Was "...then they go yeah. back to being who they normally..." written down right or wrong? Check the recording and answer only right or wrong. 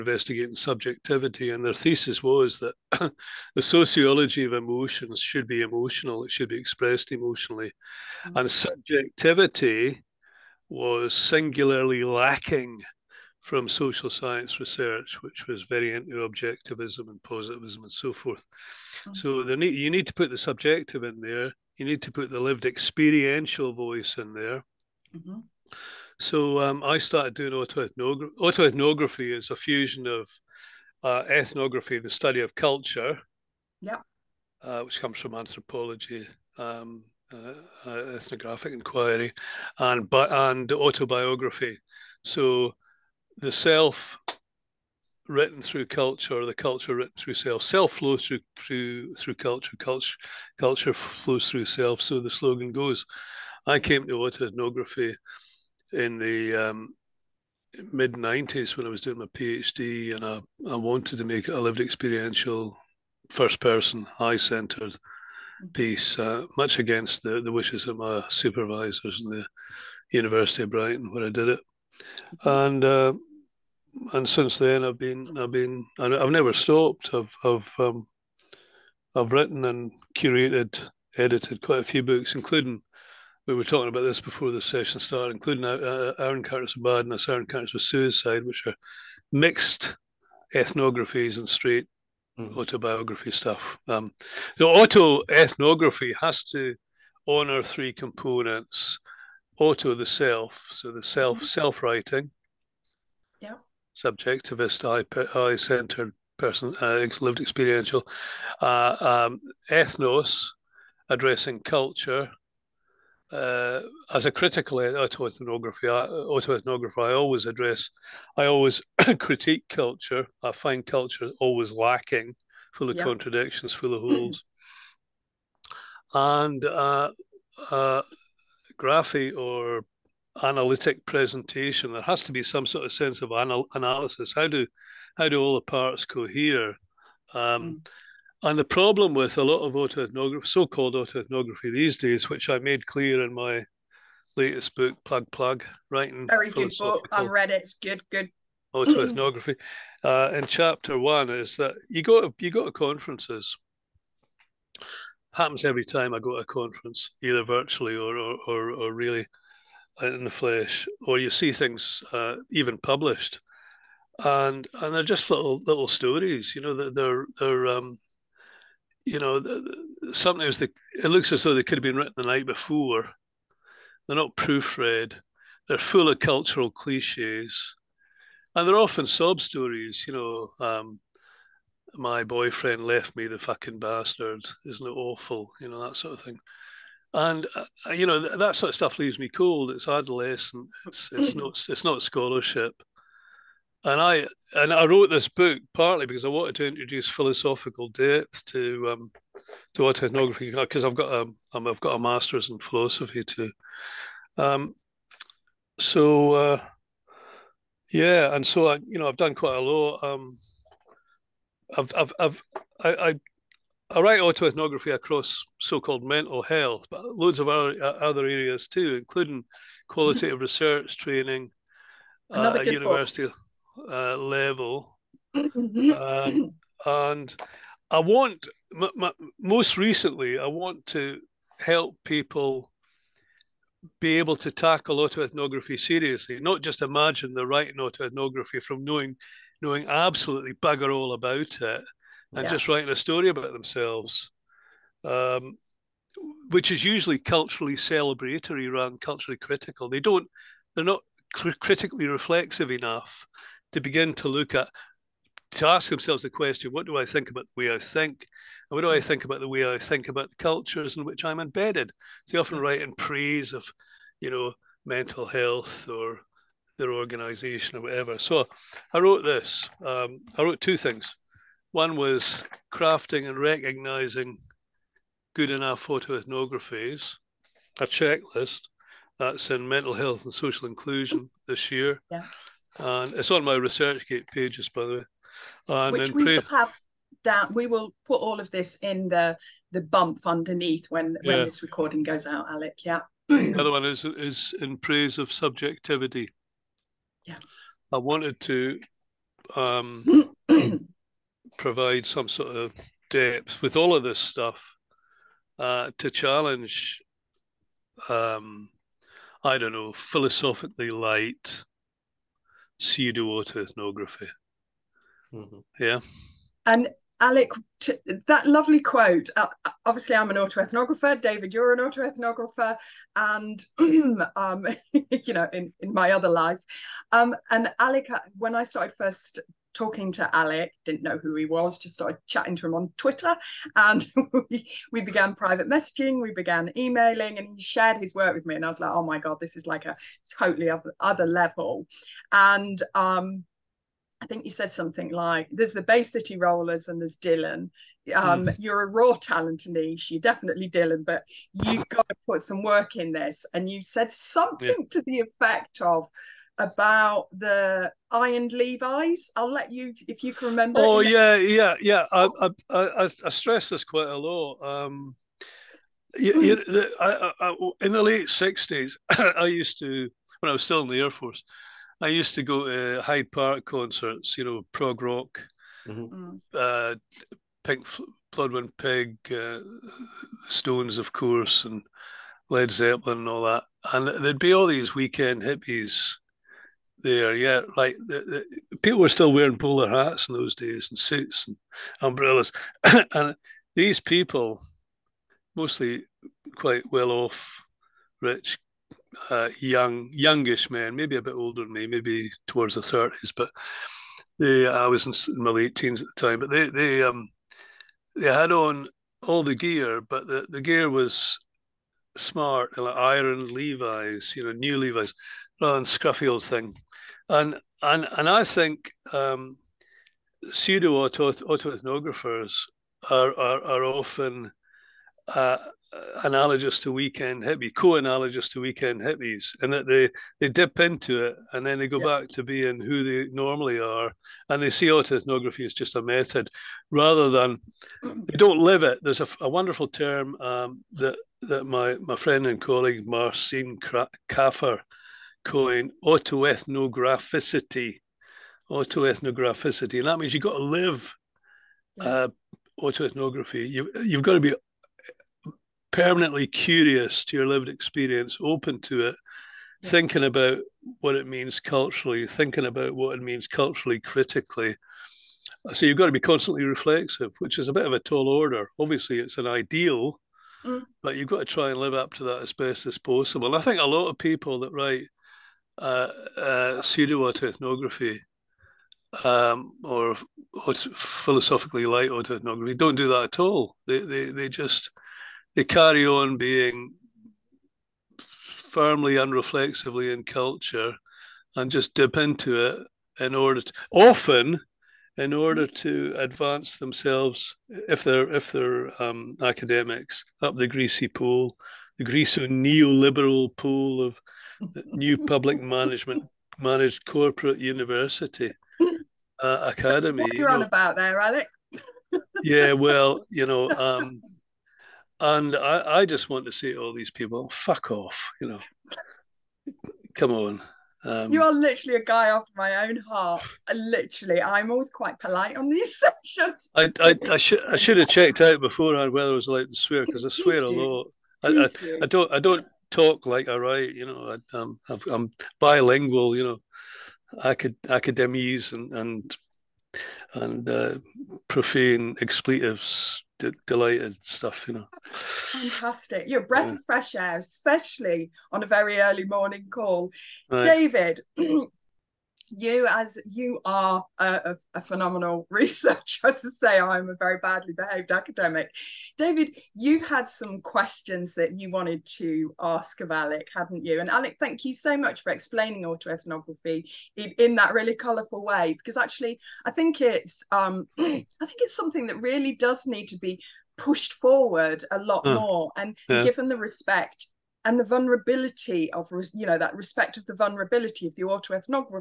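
right.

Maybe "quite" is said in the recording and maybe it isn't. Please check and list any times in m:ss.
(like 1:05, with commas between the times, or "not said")
1:21, 3:29, 6:03, 6:36, 8:44.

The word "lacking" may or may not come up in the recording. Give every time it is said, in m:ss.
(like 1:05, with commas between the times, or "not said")
0:12, 2:01.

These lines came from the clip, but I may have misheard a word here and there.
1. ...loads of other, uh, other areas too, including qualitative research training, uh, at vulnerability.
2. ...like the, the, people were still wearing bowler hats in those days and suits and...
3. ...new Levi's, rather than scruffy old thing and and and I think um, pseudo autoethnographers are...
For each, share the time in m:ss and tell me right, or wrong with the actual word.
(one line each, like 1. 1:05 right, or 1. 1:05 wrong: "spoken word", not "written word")
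1. 3:37 wrong: "university", not "vulnerability"
2. 6:27 right
3. 6:54 right.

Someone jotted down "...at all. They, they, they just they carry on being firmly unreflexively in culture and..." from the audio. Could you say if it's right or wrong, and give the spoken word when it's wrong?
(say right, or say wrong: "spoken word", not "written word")
right.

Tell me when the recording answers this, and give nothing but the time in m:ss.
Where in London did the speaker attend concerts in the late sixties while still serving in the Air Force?
6:13.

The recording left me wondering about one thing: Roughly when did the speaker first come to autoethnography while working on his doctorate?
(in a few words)
mid 90s.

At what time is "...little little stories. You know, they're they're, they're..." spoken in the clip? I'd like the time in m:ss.
2:45.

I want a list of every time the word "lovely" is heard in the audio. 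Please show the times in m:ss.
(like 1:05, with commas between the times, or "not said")
5:18.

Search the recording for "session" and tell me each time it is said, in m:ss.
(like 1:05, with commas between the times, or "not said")
1:24, 8:46.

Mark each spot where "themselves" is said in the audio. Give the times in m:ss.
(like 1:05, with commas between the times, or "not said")
4:03, 4:15, 8:16.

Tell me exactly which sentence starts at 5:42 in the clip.
And um, I think you said something like, there's the Bay City Rollers and there's Dylan.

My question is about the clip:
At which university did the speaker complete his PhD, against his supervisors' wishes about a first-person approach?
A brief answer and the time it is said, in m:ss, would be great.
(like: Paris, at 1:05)
University of Brighton, at 1:10.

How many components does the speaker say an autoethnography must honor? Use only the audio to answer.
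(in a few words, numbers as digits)
3.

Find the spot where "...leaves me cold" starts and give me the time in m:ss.
3:08.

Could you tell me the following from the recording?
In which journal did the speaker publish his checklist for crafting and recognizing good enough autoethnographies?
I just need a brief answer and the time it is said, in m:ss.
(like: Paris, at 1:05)
Mental Health and Social Inclusion, at 4:39.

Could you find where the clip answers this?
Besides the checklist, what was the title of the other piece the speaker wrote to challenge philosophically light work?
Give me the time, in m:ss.
4:54.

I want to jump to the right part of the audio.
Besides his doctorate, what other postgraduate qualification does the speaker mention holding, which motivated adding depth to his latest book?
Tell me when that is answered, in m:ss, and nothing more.
3:21.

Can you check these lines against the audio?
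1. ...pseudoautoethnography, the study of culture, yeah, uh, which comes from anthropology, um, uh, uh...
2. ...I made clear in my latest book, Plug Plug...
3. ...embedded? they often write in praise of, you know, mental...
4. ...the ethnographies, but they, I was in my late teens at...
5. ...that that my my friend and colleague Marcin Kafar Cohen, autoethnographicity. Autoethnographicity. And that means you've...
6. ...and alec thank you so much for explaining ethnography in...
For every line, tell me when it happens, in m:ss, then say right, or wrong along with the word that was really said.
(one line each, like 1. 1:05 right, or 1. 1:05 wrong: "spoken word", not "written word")
1. 0:31 wrong: "ethnography", not "pseudoautoethnography"
2. 2:22 right
3. 4:21 right
4. 6:42 wrong: "thirties", not "ethnographies"
5. 7:20 right
6. 9:24 wrong: "autoethnography", not "ethnography".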